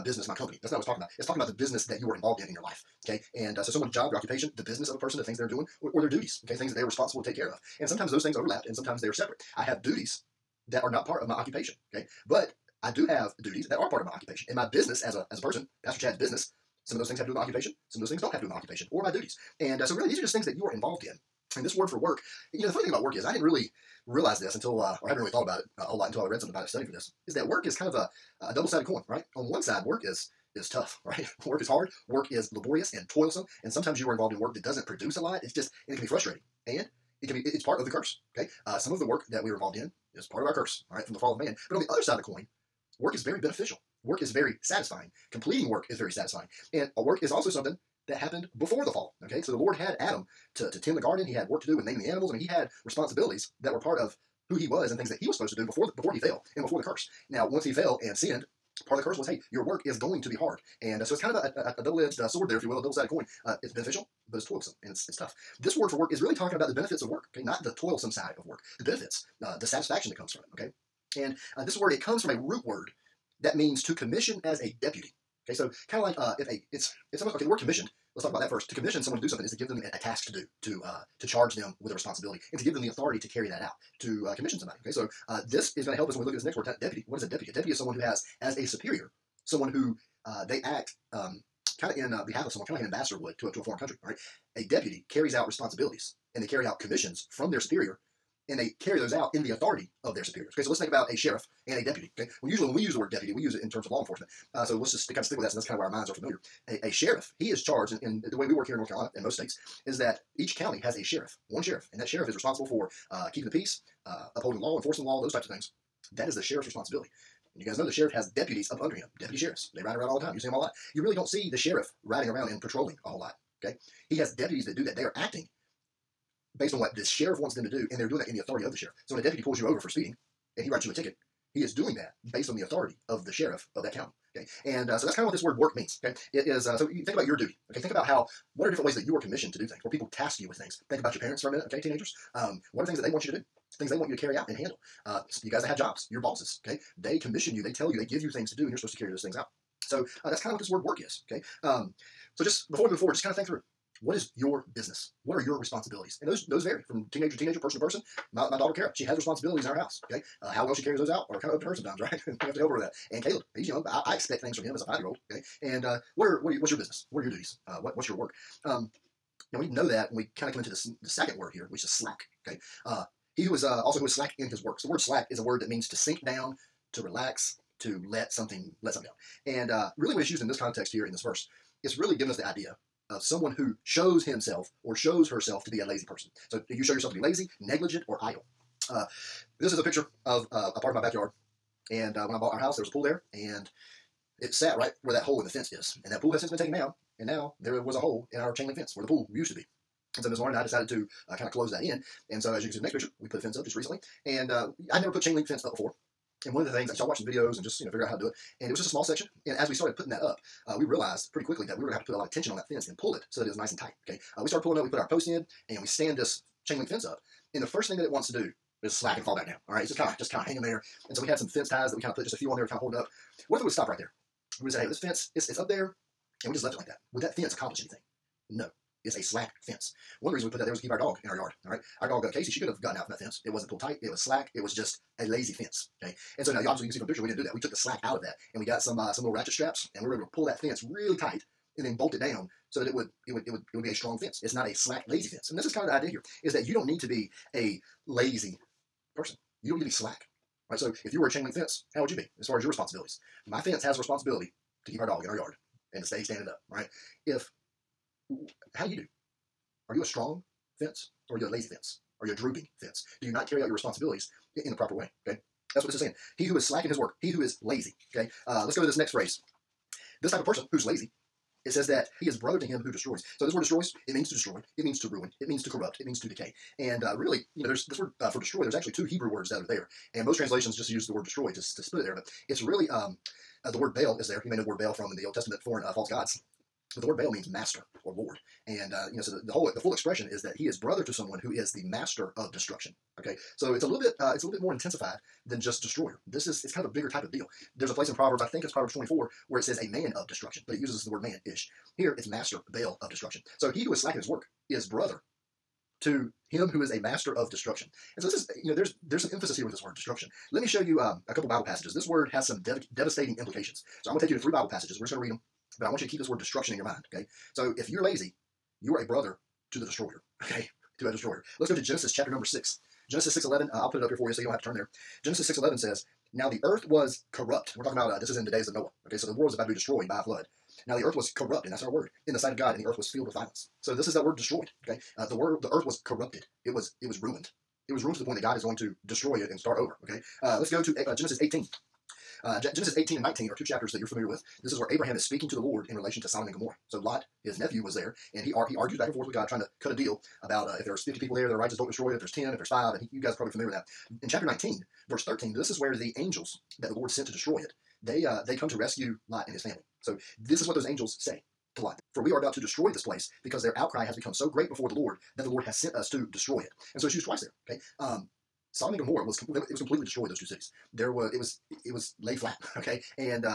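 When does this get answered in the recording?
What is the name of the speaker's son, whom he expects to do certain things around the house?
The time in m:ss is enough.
2:43.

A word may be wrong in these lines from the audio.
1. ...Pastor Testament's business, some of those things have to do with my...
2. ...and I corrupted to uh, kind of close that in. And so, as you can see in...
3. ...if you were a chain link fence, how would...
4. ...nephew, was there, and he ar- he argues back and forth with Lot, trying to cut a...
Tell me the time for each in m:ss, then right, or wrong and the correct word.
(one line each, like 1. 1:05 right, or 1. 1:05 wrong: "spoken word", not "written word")
1. 0:15 wrong: "Chad", not "Testament"
2. 3:20 wrong: "decided", not "corrupted"
3. 4:11 right
4. 5:47 wrong: "God", not "Lot".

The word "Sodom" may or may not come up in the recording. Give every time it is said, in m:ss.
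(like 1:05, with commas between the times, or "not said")
5:46, 6:08.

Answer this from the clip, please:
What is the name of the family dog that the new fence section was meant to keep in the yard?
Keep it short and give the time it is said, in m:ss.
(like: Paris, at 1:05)
Casey, at 3:52.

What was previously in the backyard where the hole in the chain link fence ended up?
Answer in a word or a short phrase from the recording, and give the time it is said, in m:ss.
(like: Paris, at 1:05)
a pool, at 3:12.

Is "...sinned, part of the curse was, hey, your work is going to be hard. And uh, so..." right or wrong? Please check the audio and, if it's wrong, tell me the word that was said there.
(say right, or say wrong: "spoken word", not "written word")
right.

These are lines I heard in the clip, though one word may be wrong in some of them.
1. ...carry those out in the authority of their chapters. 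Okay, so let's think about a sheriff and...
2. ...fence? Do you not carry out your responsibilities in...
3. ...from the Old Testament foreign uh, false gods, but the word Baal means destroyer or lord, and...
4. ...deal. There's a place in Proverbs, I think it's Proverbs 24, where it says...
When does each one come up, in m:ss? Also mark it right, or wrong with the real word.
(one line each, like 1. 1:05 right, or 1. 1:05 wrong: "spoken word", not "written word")
1. 1:38 wrong: "superiors", not "chapters"
2. 4:22 right
3. 4:44 wrong: "master", not "destroyer"
4. 4:57 right.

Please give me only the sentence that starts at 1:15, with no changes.
Okay, so kind of like uh, if a it's it's almost okay.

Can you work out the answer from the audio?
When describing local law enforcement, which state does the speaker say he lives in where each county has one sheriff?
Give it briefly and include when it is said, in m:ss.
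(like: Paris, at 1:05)
North Carolina, at 1:48.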